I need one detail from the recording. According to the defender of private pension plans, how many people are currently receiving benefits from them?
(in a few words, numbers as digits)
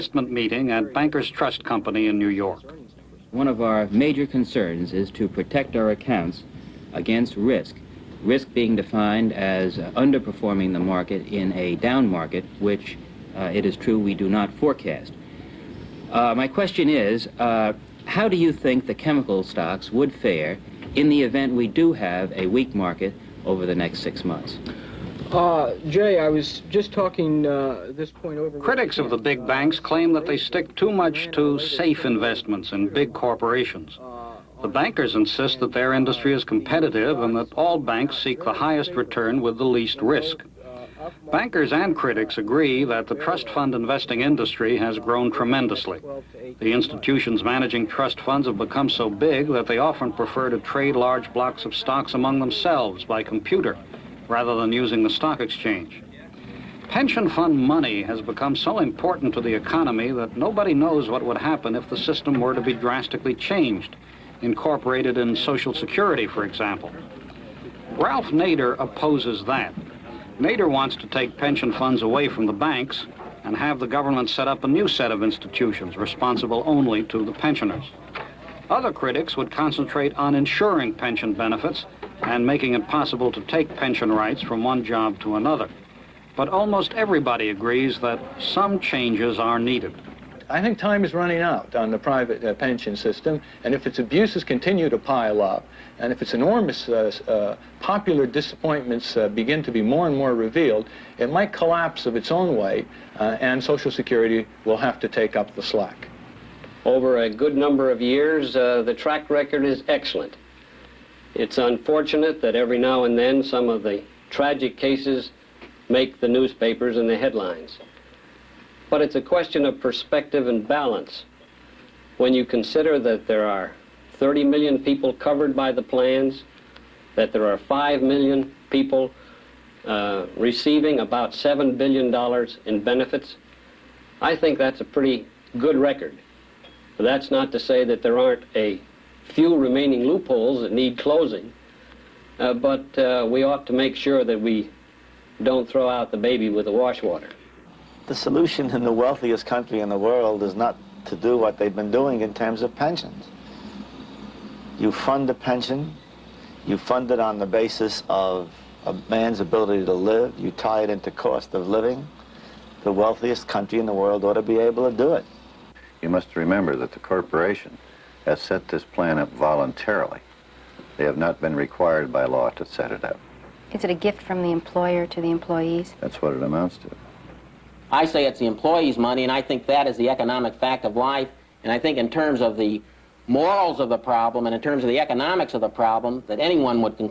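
5 million.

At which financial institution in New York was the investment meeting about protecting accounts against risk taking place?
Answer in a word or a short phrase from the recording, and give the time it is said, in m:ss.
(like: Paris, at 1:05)
Bankers Trust Company, at 0:00.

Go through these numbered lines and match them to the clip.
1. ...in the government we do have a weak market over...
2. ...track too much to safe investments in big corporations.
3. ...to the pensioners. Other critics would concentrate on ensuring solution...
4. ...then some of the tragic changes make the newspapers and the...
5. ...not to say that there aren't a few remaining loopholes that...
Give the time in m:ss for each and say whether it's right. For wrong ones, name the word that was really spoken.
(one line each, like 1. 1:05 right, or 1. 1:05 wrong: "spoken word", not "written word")
1. 0:20 wrong: "event", not "government"
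2. 0:30 wrong: "stick", not "track"
3. 1:17 wrong: "pension", not "solution"
4. 1:53 wrong: "cases", not "changes"
5. 2:17 right.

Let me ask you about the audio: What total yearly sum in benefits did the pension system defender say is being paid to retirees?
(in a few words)
$7 billion.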